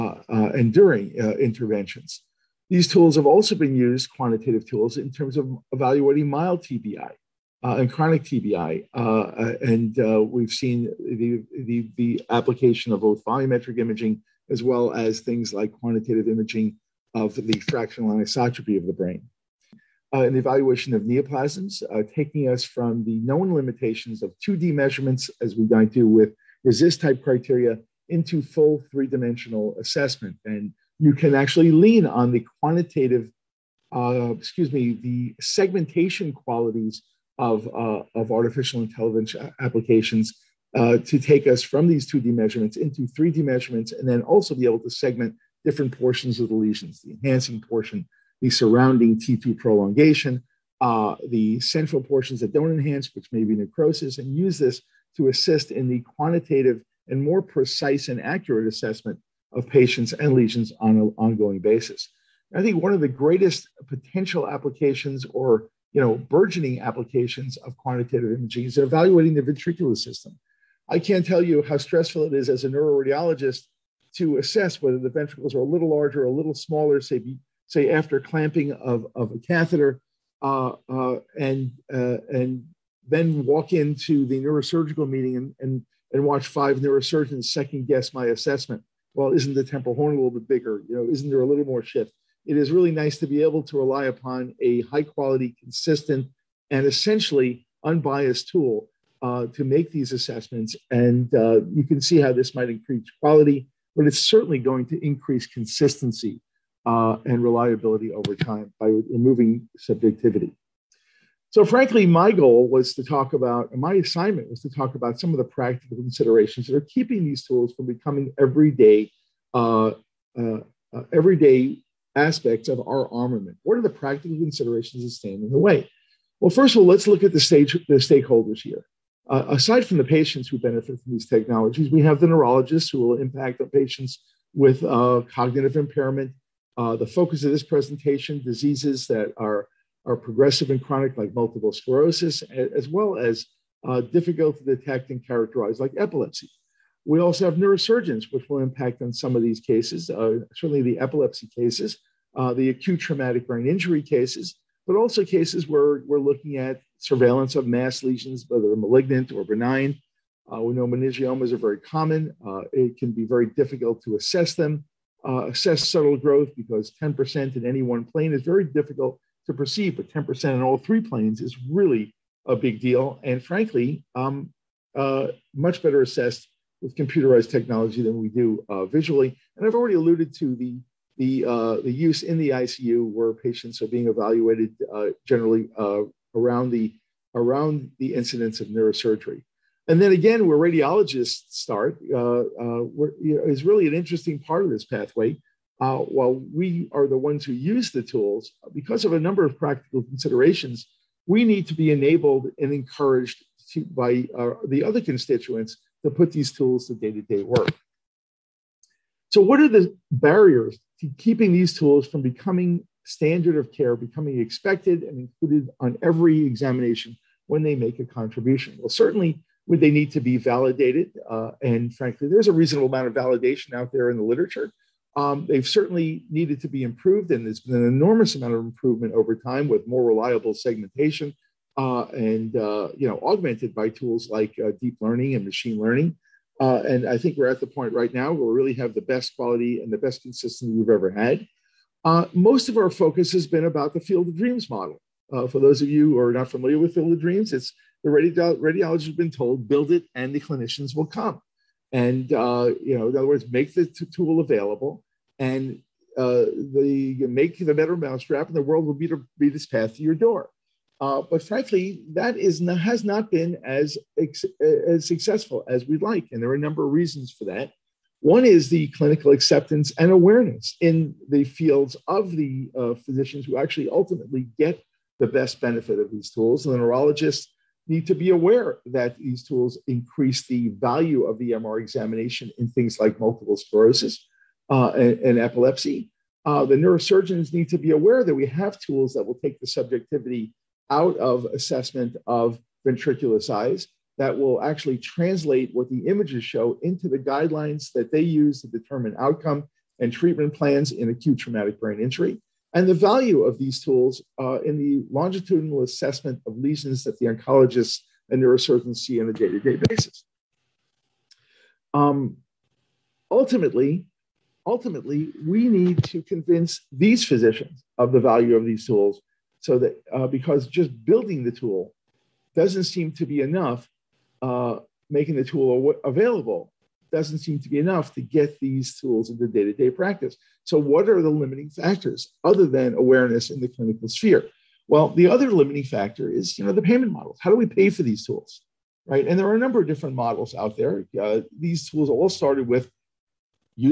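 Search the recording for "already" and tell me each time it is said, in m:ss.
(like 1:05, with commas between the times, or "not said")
2:59.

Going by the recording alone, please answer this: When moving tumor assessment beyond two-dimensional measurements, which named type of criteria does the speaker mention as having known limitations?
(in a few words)
RECIST.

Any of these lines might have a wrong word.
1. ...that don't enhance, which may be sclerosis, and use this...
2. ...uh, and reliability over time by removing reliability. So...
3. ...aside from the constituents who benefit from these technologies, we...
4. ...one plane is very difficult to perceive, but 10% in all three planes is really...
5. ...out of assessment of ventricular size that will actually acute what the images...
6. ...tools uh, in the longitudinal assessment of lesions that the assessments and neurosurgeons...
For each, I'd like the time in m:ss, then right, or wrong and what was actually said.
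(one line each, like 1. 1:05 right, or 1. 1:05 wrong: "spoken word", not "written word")
1. 0:52 wrong: "necrosis", not "sclerosis"
2. 1:46 wrong: "subjectivity", not "reliability"
3. 2:09 wrong: "patients", not "constituents"
4. 2:47 right
5. 4:50 wrong: "translate", not "acute"
6. 5:03 wrong: "oncologists", not "assessments".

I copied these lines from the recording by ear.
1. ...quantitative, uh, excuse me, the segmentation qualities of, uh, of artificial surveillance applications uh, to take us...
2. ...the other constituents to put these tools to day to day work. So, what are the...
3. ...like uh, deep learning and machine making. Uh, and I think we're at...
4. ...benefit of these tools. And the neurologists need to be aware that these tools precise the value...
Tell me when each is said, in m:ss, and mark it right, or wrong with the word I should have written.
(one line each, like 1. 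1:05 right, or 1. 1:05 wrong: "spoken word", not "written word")
1. 0:32 wrong: "intelligence", not "surveillance"
2. 3:24 right
3. 3:54 wrong: "learning", not "making"
4. 4:35 wrong: "increase", not "precise".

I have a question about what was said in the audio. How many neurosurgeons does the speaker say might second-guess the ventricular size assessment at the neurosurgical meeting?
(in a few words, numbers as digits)
5.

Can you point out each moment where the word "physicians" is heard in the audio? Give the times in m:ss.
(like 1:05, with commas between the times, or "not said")
4:32, 5:17.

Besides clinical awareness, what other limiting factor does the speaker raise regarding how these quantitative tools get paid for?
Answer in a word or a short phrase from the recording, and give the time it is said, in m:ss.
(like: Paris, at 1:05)
payment models, at 5:36.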